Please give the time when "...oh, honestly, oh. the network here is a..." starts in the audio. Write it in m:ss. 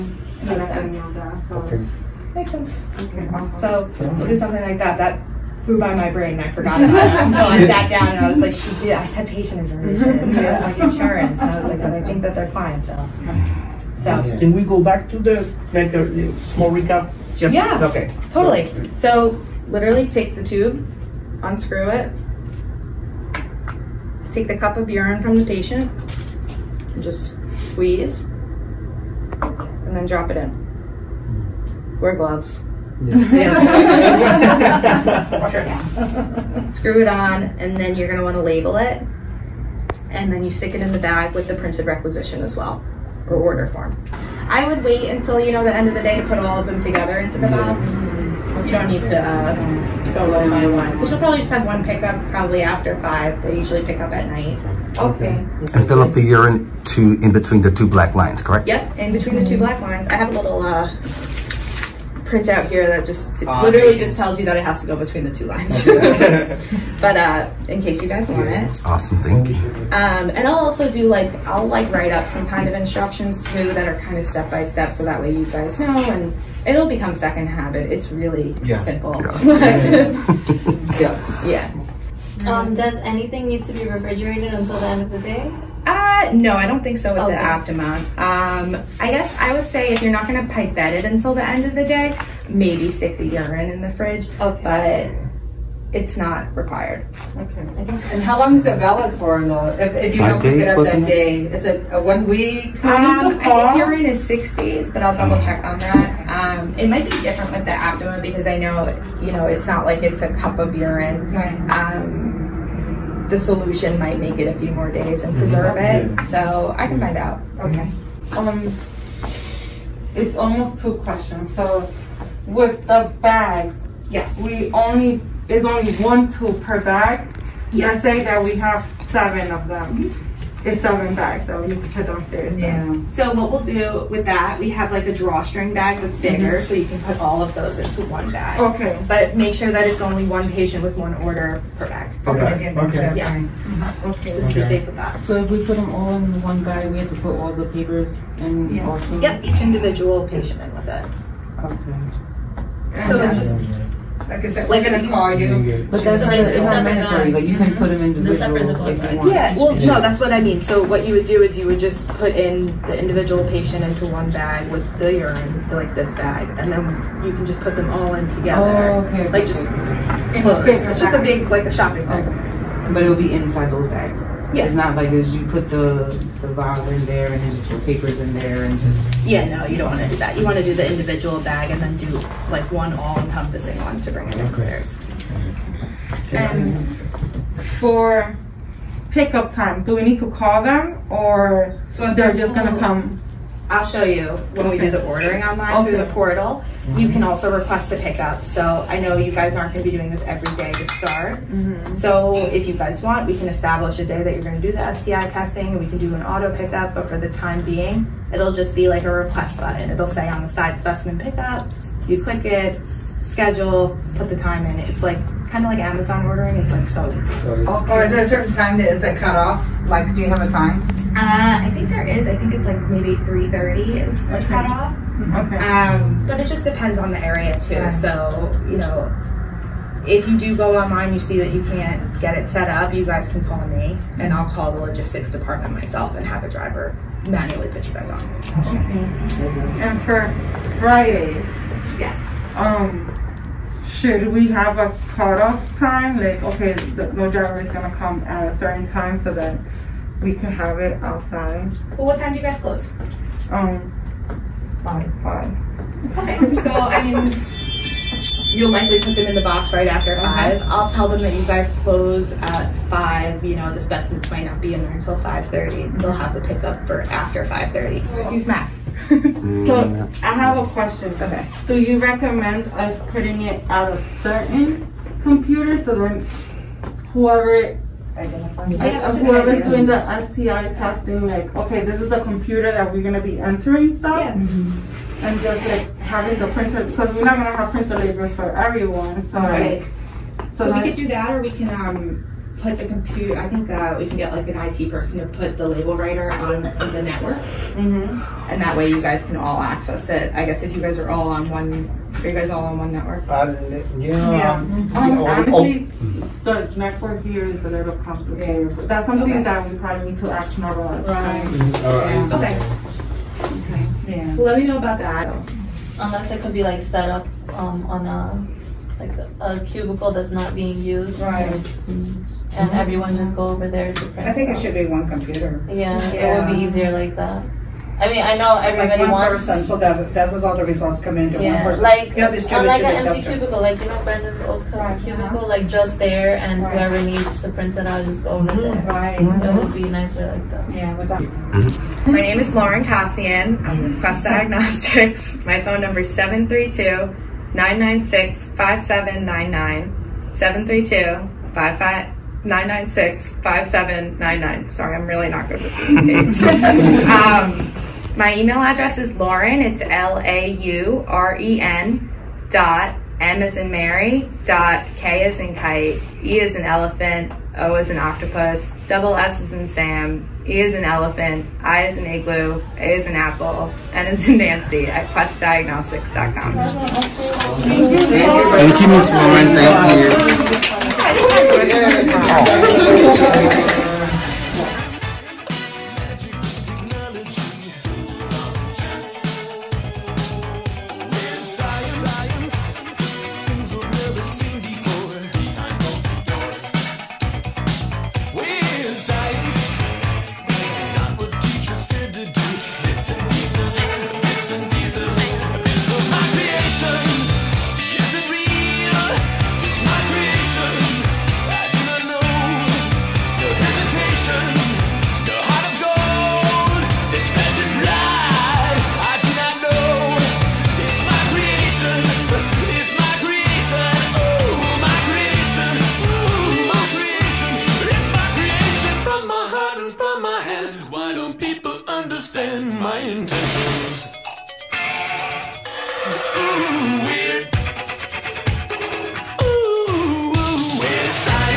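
5:05.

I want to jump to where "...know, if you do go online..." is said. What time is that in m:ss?
3:48.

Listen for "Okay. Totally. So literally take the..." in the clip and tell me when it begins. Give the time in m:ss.
0:17.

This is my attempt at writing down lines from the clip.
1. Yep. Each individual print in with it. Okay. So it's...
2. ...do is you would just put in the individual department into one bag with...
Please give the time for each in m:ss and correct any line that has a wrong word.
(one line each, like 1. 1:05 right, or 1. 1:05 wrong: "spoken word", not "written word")
1. 2:29 wrong: "patient", not "print"
2. 2:41 wrong: "patient", not "department".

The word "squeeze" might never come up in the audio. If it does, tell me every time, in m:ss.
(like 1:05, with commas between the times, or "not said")
0:27.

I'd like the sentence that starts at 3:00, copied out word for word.
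You want to do the individual bag and then do like one all encompassing one to bring it downstairs.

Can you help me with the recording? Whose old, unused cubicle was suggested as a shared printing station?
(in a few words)
Brendan.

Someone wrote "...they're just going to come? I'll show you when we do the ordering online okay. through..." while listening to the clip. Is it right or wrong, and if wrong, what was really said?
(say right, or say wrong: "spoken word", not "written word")
right.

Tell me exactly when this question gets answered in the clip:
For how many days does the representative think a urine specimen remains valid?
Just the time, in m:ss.
1:44.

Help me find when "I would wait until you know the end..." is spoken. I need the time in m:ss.
0:44.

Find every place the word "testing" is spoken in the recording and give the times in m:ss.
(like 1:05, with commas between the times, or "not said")
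3:25, 4:40.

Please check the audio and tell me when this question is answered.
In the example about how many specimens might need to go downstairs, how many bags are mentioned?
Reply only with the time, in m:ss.
2:10.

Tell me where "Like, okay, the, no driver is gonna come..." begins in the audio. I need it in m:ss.
4:06.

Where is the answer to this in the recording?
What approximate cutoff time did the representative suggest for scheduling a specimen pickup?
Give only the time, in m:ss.
3:43.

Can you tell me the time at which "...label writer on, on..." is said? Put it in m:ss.
4:55.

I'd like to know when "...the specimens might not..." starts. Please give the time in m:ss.
4:23.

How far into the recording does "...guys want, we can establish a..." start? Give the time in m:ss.
3:22.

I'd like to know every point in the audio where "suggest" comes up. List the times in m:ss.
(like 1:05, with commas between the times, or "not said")
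not said.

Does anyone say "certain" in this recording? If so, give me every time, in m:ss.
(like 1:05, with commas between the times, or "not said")
3:38, 4:08, 4:34.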